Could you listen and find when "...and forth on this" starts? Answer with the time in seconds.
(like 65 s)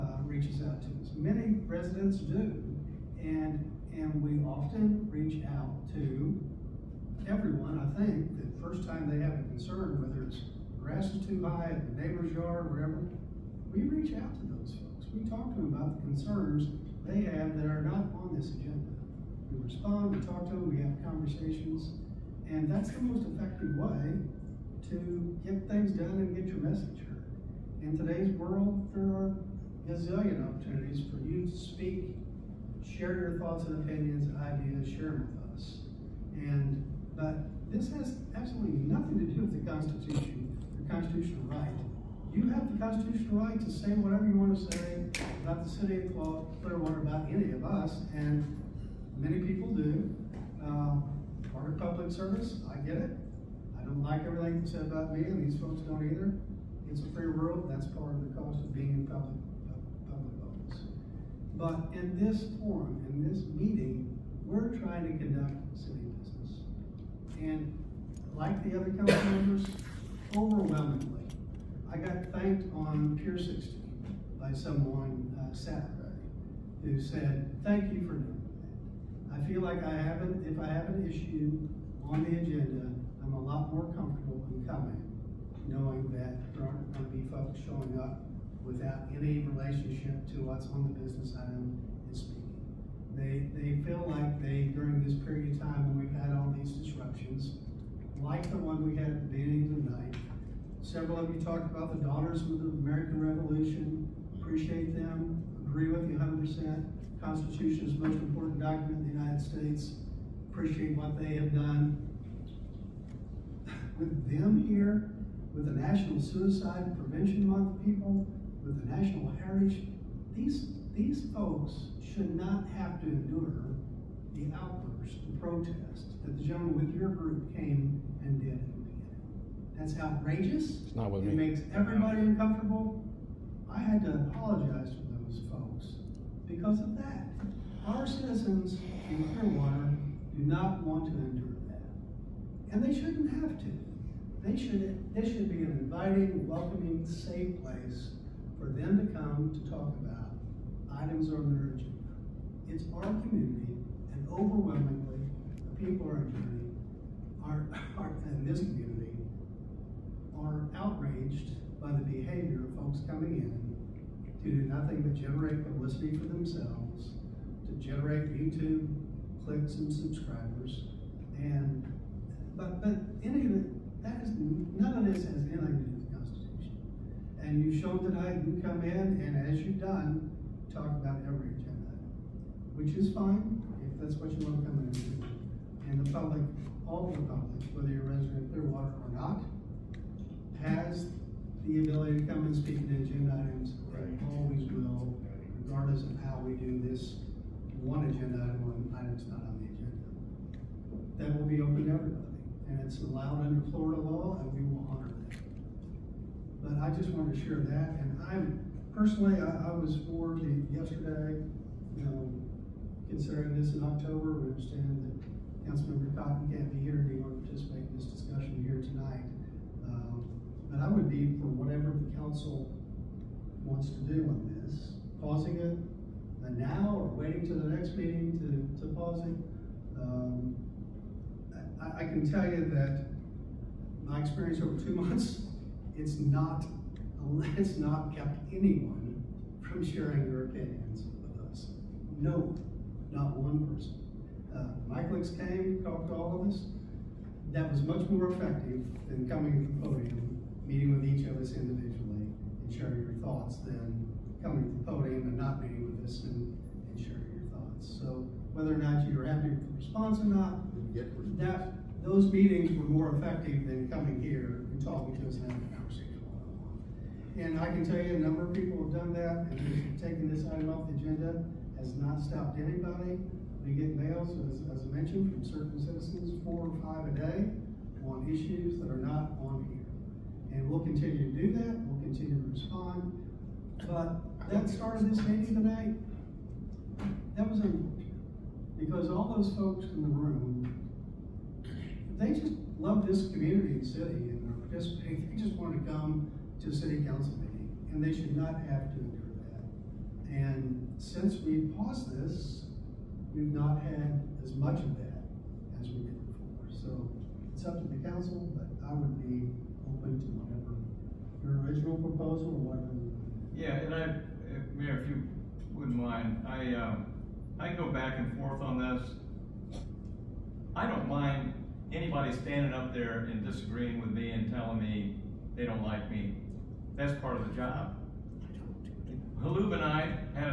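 318 s.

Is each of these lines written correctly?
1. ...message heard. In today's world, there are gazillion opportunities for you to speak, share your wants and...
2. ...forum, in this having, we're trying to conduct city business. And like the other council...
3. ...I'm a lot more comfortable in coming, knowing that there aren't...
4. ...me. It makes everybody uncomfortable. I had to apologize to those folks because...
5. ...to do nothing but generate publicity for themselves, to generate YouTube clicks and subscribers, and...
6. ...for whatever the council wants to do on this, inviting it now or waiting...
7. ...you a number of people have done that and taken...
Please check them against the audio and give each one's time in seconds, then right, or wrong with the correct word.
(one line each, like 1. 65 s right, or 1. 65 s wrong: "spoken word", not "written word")
1. 26 s wrong: "thoughts", not "wants"
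2. 62 s wrong: "meeting", not "having"
3. 83 s right
4. 131 s right
5. 164 s right
6. 221 s wrong: "pausing", not "inviting"
7. 267 s right.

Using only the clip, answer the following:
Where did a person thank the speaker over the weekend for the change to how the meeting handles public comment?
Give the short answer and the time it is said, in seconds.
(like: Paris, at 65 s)
Pier 60, at 73 s.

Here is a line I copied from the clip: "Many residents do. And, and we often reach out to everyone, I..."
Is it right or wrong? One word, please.
right.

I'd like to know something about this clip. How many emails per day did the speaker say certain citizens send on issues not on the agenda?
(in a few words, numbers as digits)
4 or 5.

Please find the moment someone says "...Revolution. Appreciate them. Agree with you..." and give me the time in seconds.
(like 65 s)
103 s.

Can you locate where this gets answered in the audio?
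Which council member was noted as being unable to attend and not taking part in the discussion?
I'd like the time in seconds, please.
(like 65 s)
215 s.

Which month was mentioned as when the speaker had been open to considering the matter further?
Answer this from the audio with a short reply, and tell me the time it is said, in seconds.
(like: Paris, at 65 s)
October, at 213 s.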